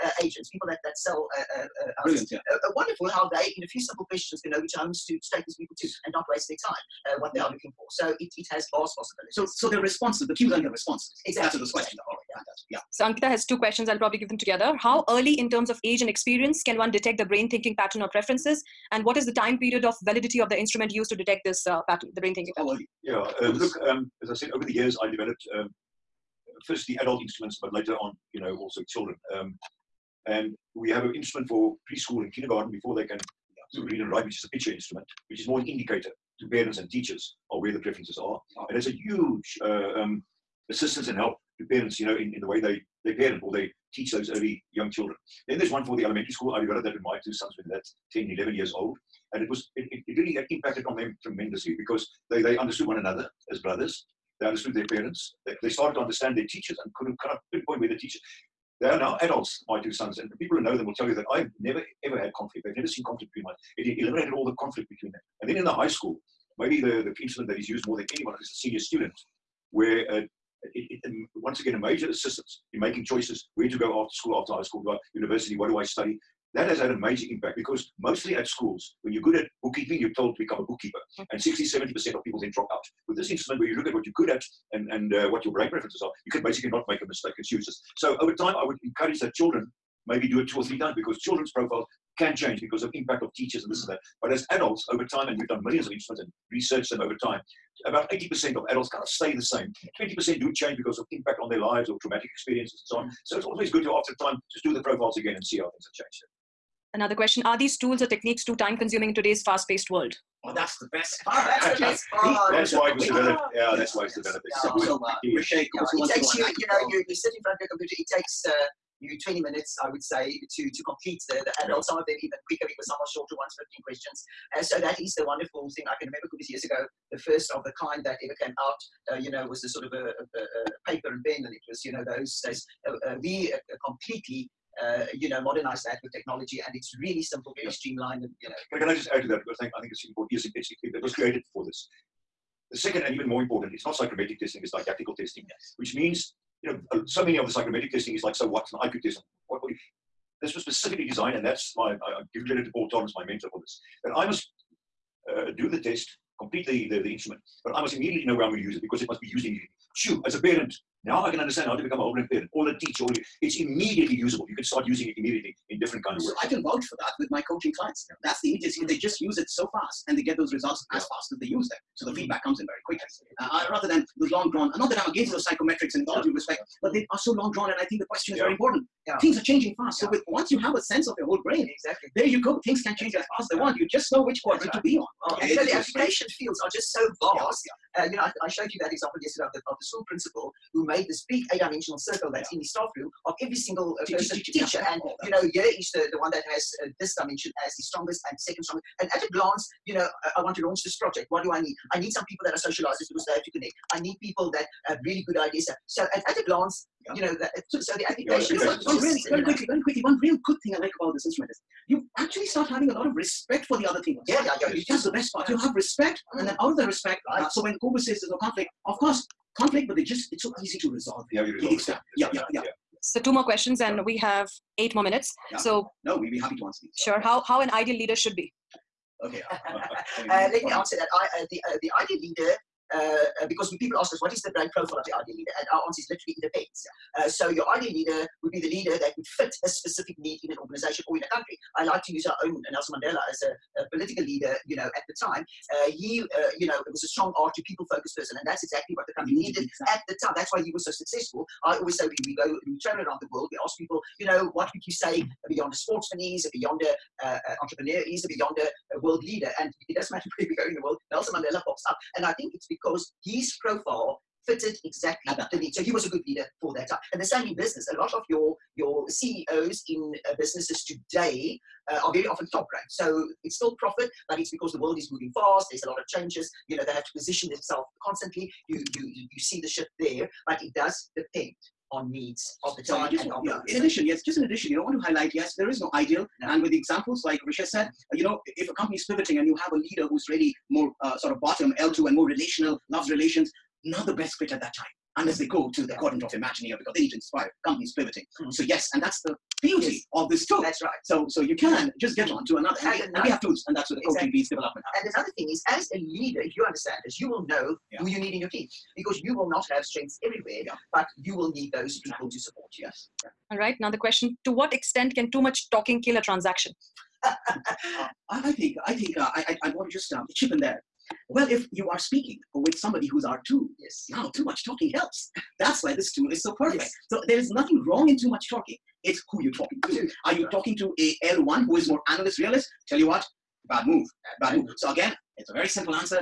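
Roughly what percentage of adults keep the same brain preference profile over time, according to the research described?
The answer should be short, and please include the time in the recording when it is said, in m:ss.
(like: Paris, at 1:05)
80%, at 1:37.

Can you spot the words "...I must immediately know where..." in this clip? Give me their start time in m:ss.
2:37.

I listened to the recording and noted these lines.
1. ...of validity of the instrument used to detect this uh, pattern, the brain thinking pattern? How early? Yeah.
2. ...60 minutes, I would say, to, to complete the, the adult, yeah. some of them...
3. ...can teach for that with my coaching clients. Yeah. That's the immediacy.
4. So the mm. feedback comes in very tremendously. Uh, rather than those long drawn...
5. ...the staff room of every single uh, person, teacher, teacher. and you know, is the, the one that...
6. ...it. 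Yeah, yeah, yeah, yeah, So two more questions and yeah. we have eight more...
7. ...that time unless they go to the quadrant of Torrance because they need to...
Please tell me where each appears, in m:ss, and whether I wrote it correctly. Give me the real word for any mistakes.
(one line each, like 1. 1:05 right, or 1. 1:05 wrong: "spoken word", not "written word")
1. 0:19 right
2. 1:59 wrong: "20", not "60"
3. 2:46 wrong: "vouch", not "teach"
4. 2:51 wrong: "quickly", not "tremendously"
5. 3:12 right
6. 3:41 right
7. 4:54 wrong: "Imagineer", not "Torrance".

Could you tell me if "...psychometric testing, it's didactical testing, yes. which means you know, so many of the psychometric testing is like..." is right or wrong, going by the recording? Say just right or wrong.
right.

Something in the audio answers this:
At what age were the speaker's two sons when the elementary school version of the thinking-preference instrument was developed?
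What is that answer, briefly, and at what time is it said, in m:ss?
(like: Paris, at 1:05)
10, 11, at 0:48.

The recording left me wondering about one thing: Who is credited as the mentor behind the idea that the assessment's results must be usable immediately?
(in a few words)
Paul Torrance.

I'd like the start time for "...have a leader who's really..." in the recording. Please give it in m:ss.
4:49.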